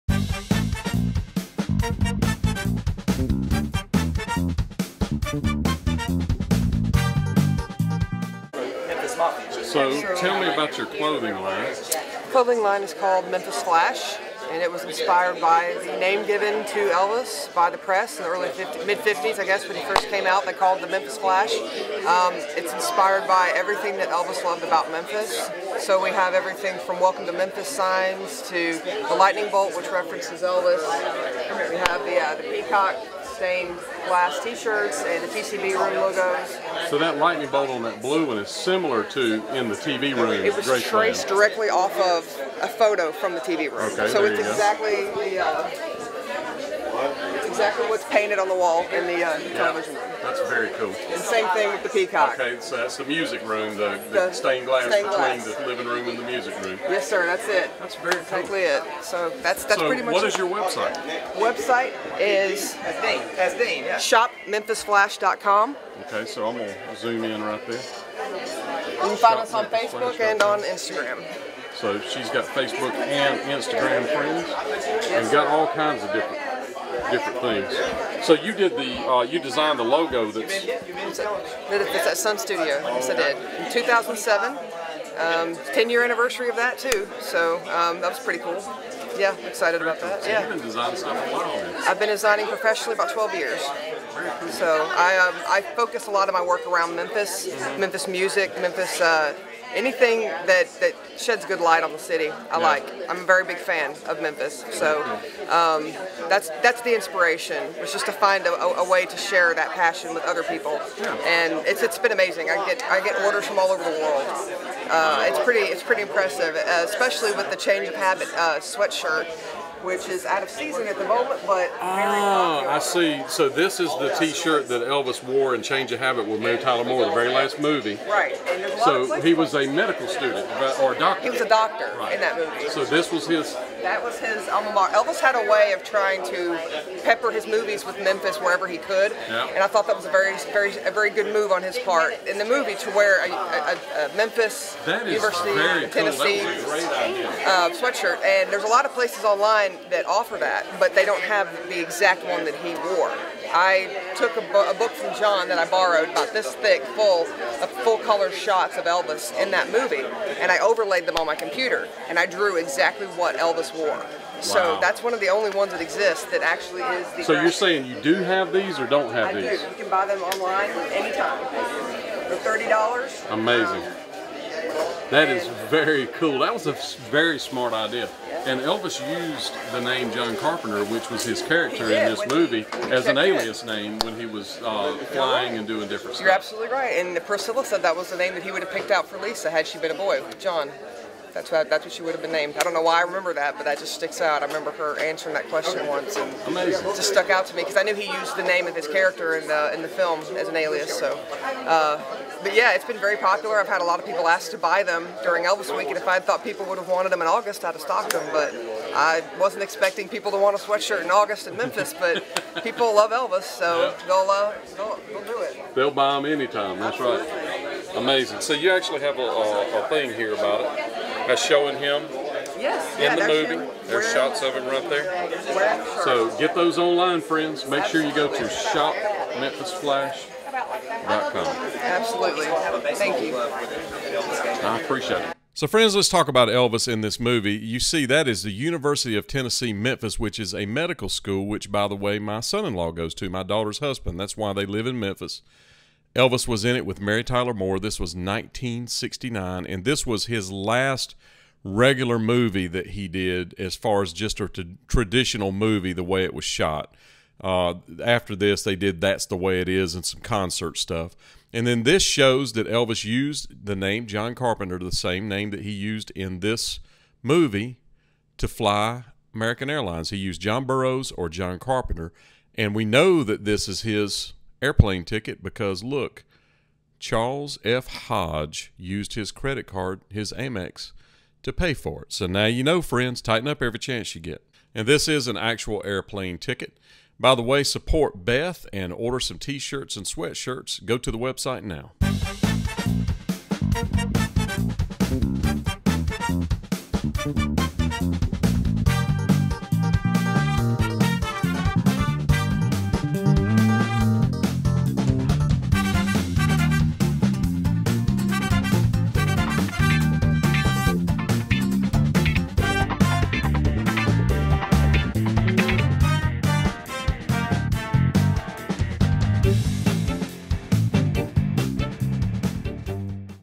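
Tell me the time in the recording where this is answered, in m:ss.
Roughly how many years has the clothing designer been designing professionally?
1:32.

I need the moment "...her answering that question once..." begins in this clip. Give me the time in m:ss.
3:14.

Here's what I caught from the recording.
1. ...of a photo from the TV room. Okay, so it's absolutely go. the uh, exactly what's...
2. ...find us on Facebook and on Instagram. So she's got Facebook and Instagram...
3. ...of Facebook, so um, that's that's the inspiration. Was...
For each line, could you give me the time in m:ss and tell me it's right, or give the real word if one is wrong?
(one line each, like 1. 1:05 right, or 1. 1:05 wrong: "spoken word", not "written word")
1. 0:41 wrong: "exactly", not "absolutely"
2. 1:09 right
3. 1:44 wrong: "Memphis", not "Facebook".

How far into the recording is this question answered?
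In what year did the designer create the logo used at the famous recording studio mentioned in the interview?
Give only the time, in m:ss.
1:23.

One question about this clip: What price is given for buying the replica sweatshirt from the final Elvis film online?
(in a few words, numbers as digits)
$30.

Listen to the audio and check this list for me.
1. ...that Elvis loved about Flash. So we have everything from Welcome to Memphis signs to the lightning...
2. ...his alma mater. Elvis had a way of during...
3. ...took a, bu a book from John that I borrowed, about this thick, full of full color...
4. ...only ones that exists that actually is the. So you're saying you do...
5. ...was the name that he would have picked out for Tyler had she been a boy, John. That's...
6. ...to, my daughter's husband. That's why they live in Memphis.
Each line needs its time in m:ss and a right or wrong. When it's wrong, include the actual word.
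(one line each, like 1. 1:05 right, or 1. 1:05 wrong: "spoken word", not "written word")
1. 0:23 wrong: "Memphis", not "Flash"
2. 2:14 wrong: "trying", not "during"
3. 2:34 right
4. 2:45 right
5. 3:07 wrong: "Lisa", not "Tyler"
6. 4:03 right.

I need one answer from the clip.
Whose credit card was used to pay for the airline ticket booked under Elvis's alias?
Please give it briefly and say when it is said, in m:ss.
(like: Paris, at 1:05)
Charles F. Hodge, at 4:36.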